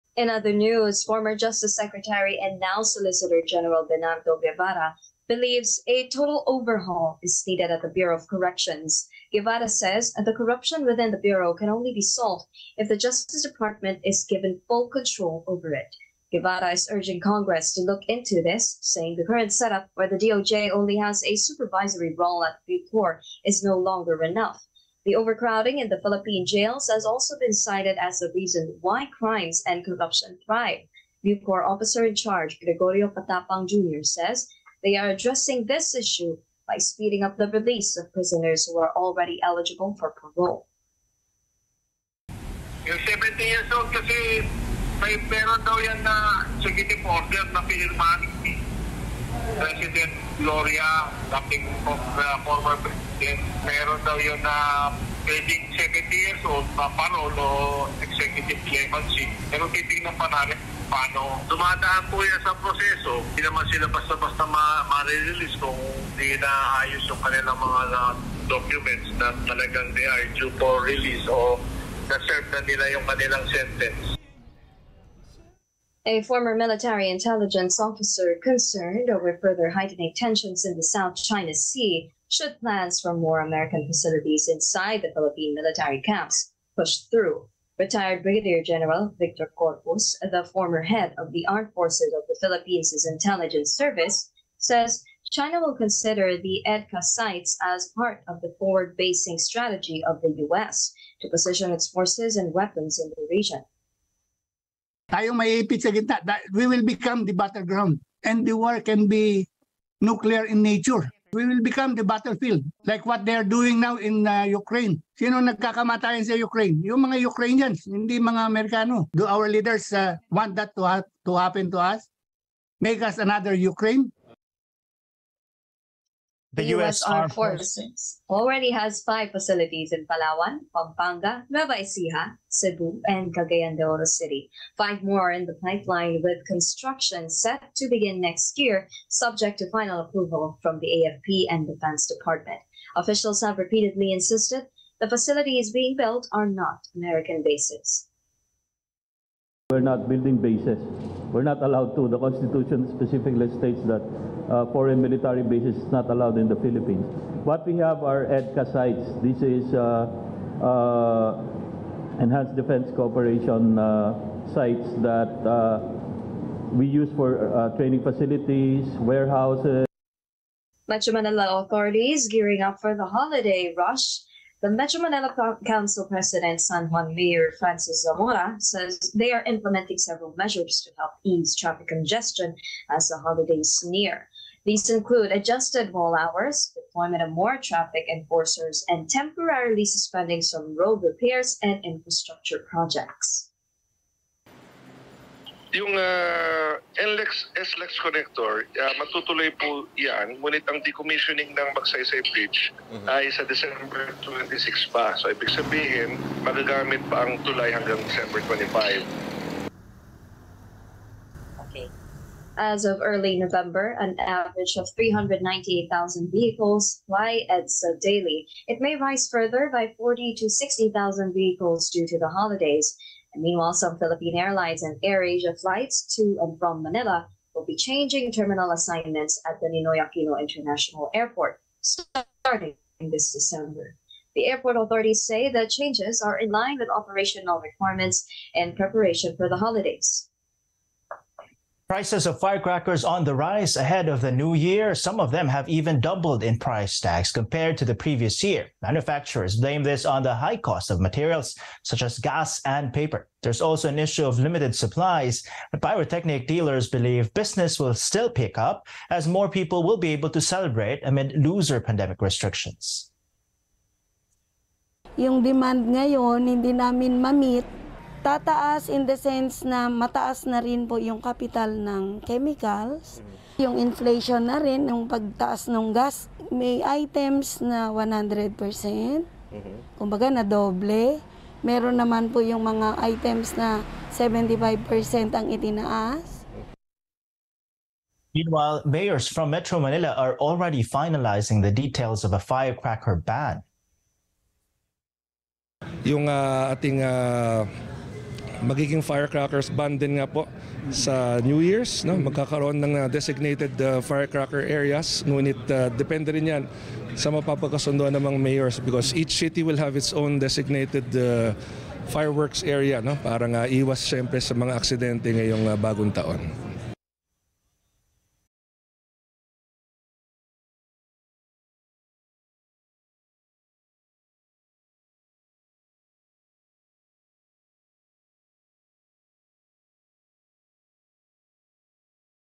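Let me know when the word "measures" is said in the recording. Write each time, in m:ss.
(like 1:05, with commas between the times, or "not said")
3:00.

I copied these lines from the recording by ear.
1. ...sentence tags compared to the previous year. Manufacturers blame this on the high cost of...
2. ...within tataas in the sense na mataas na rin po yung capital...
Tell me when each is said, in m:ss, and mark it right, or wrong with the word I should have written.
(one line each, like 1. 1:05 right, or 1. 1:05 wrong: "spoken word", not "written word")
1. 4:06 wrong: "price", not "sentence"
2. 4:26 wrong: "namin", not "within".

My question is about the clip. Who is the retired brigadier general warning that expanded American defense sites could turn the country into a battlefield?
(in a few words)
Victor Corpus.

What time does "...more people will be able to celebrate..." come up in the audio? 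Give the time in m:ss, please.
4:19.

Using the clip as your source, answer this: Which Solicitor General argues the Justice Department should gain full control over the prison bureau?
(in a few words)
Bernardo Guevarra.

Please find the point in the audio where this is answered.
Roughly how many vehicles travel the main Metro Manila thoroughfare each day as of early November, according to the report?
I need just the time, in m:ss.
3:34.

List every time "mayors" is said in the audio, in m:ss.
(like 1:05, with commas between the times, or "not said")
2:57, 4:48, 5:08.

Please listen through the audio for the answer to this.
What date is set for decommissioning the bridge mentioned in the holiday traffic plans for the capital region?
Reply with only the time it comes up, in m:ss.
3:23.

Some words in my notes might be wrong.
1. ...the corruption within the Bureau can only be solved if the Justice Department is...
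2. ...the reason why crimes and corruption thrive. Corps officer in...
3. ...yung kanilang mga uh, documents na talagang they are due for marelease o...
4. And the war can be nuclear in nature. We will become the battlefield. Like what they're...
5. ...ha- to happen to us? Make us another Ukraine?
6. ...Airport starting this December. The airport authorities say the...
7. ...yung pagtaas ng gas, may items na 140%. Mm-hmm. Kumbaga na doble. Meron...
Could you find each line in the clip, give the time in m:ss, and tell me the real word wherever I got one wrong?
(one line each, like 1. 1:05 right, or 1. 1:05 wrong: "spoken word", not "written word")
1. 0:10 right
2. 0:28 right
3. 1:07 wrong: "release", not "marelease"
4. 1:48 right
5. 2:00 right
6. 3:51 right
7. 4:34 wrong: "100", not "140".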